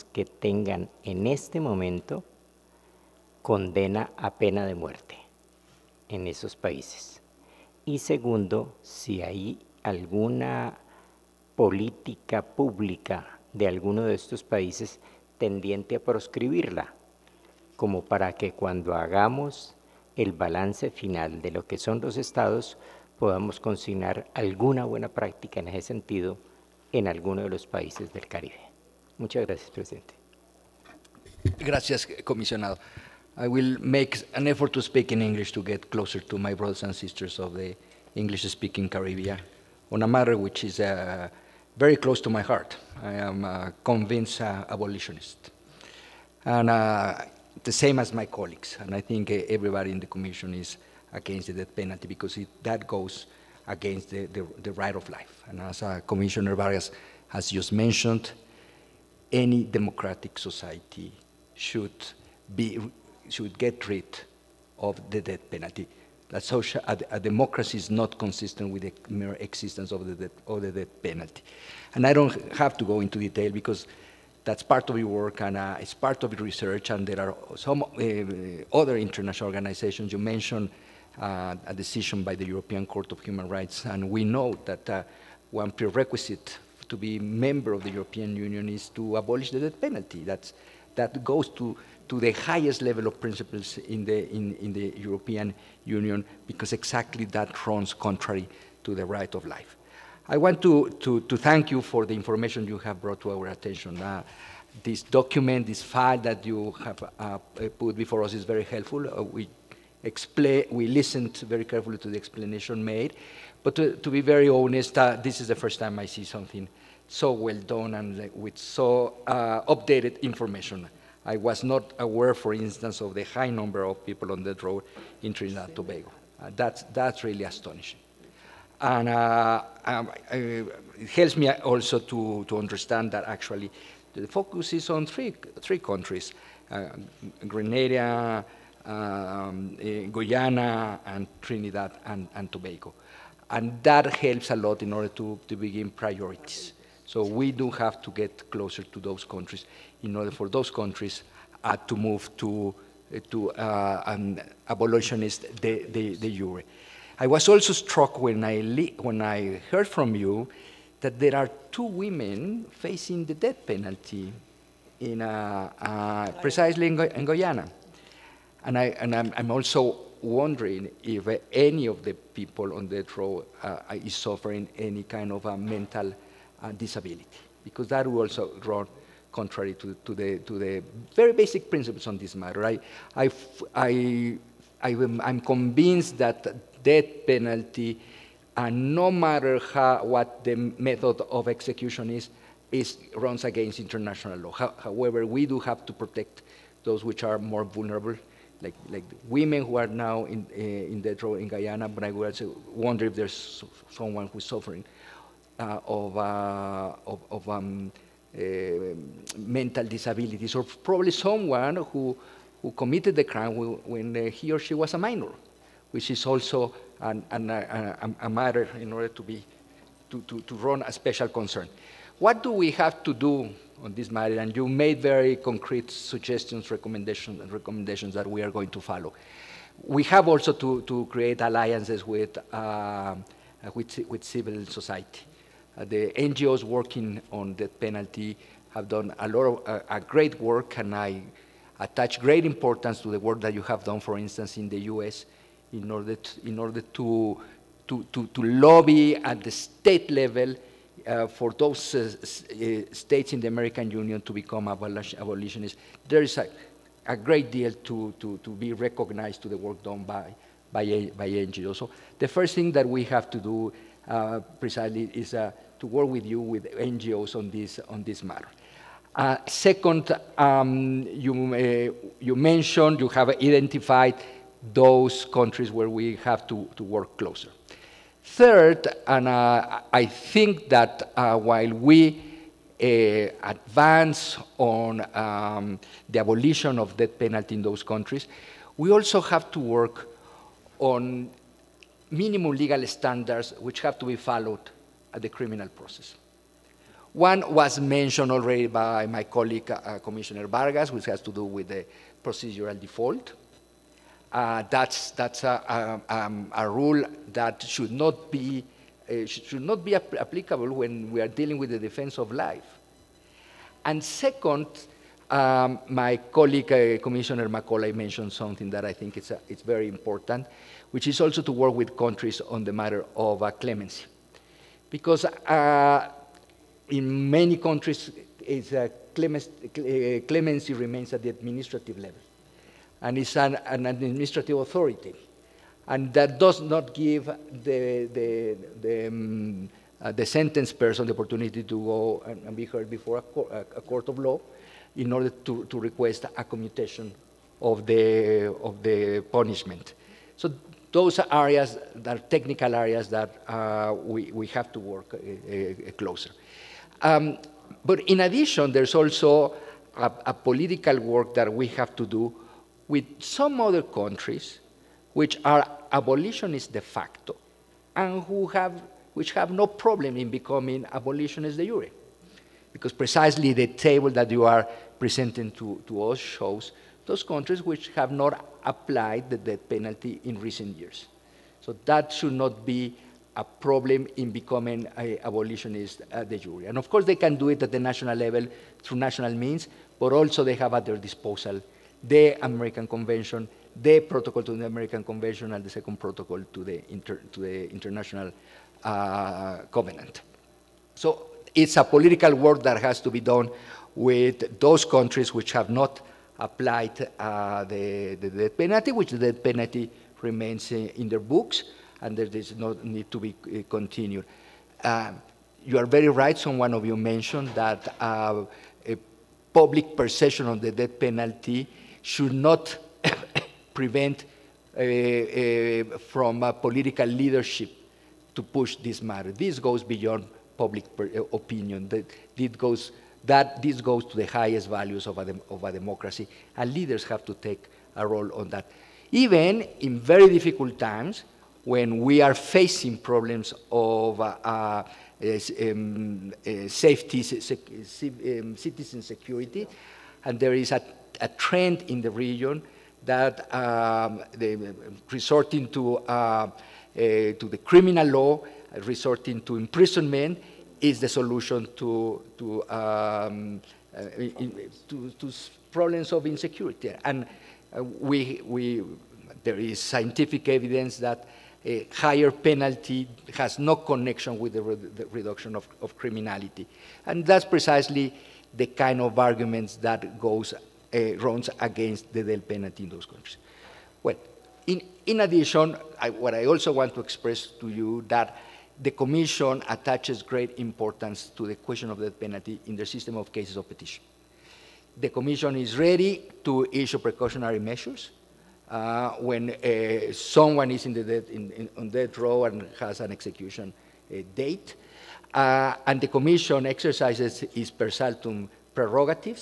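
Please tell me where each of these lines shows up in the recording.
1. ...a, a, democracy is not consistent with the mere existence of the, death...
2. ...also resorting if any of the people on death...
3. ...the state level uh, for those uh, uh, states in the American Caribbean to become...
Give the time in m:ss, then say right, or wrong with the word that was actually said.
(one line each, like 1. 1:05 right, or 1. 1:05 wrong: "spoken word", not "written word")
1. 1:06 right
2. 2:49 wrong: "wondering", not "resorting"
3. 4:09 wrong: "Union", not "Caribbean".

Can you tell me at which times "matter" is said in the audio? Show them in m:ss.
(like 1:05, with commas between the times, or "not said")
0:40, 3:02, 3:09, 3:38, 3:44, 4:28, 5:22, 7:09.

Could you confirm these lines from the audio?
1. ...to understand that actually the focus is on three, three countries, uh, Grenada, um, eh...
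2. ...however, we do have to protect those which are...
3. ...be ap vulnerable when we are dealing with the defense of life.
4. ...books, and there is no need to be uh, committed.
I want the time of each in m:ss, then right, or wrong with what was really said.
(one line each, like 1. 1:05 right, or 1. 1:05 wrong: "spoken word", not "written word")
1. 2:12 right
2. 3:14 right
3. 5:09 wrong: "applicable", not "vulnerable"
4. 6:51 wrong: "continued", not "committed".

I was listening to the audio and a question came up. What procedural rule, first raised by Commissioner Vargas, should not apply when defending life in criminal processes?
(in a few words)
procedural default.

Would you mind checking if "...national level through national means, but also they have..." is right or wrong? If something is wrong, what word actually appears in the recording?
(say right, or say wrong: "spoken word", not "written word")
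right.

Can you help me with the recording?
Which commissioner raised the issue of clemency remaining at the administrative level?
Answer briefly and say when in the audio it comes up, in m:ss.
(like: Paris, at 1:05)
Macaulay, at 5:17.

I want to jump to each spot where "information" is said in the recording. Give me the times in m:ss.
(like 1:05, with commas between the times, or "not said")
1:42, 2:00.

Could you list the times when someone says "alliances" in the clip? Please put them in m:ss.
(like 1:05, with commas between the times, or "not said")
3:51.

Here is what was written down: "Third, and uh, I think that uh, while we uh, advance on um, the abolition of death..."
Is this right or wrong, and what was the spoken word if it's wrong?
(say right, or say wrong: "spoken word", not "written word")
right.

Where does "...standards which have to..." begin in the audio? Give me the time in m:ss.
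4:52.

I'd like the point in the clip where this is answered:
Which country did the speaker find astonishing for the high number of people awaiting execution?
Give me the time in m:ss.
2:05.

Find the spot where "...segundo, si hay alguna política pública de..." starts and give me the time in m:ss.
0:07.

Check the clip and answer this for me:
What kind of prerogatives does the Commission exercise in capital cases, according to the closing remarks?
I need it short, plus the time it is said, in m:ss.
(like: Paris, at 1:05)
per saltum, at 8:27.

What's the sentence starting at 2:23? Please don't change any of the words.
And that helps a lot in order to, to begin priorities.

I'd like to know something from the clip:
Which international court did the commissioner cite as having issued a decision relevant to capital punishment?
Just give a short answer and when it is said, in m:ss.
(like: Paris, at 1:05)
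European Court of Human Rights, at 1:22.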